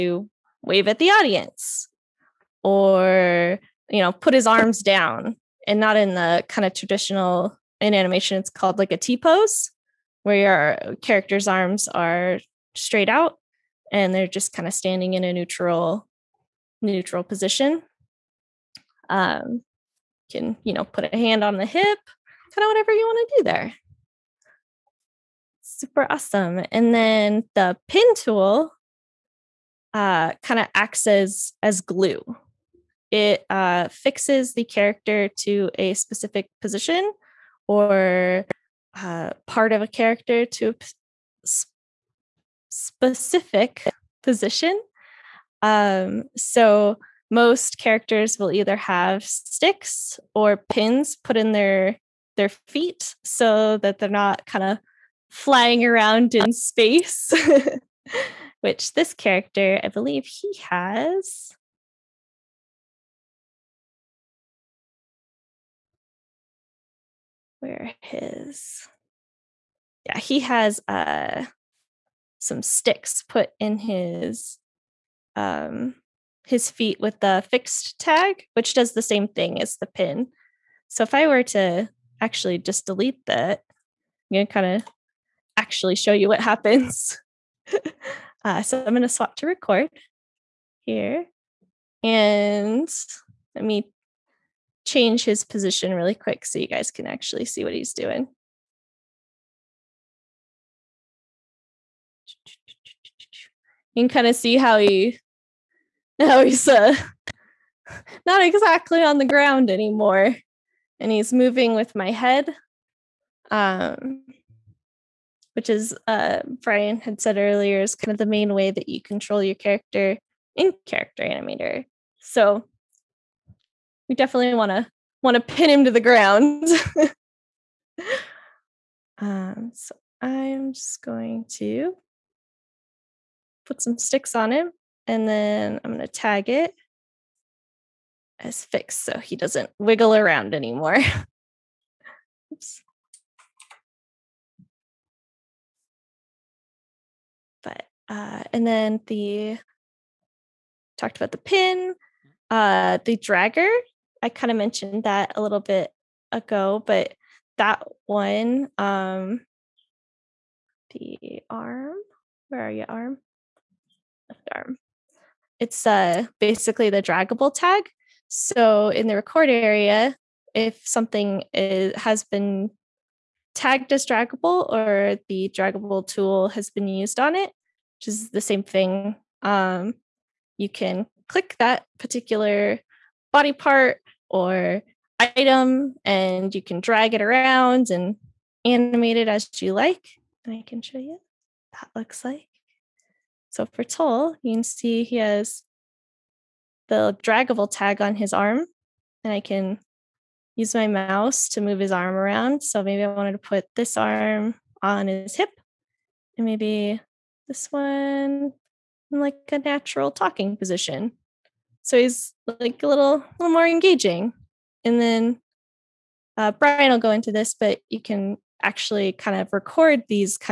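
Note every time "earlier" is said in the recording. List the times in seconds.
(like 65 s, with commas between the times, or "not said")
117 s.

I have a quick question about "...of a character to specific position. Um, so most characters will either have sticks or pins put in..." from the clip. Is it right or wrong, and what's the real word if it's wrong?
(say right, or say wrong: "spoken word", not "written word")
right.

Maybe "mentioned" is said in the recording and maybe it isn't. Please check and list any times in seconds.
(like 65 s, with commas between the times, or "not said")
154 s.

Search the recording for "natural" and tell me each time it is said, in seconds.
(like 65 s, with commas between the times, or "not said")
209 s.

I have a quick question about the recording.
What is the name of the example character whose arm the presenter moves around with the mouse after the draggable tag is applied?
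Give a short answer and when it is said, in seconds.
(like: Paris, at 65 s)
Toll, at 193 s.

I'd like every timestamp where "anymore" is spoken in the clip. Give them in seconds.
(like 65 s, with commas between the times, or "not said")
109 s, 140 s.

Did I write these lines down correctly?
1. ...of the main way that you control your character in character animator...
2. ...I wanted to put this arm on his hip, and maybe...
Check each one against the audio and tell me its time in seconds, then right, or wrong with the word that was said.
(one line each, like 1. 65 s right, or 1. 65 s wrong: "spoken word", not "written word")
1. 118 s right
2. 203 s right.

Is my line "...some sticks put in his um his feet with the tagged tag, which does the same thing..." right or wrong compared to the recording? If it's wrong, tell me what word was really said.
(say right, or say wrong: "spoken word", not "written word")
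wrong: "fixed", not "tagged".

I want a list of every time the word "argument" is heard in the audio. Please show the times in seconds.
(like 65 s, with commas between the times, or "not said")
not said.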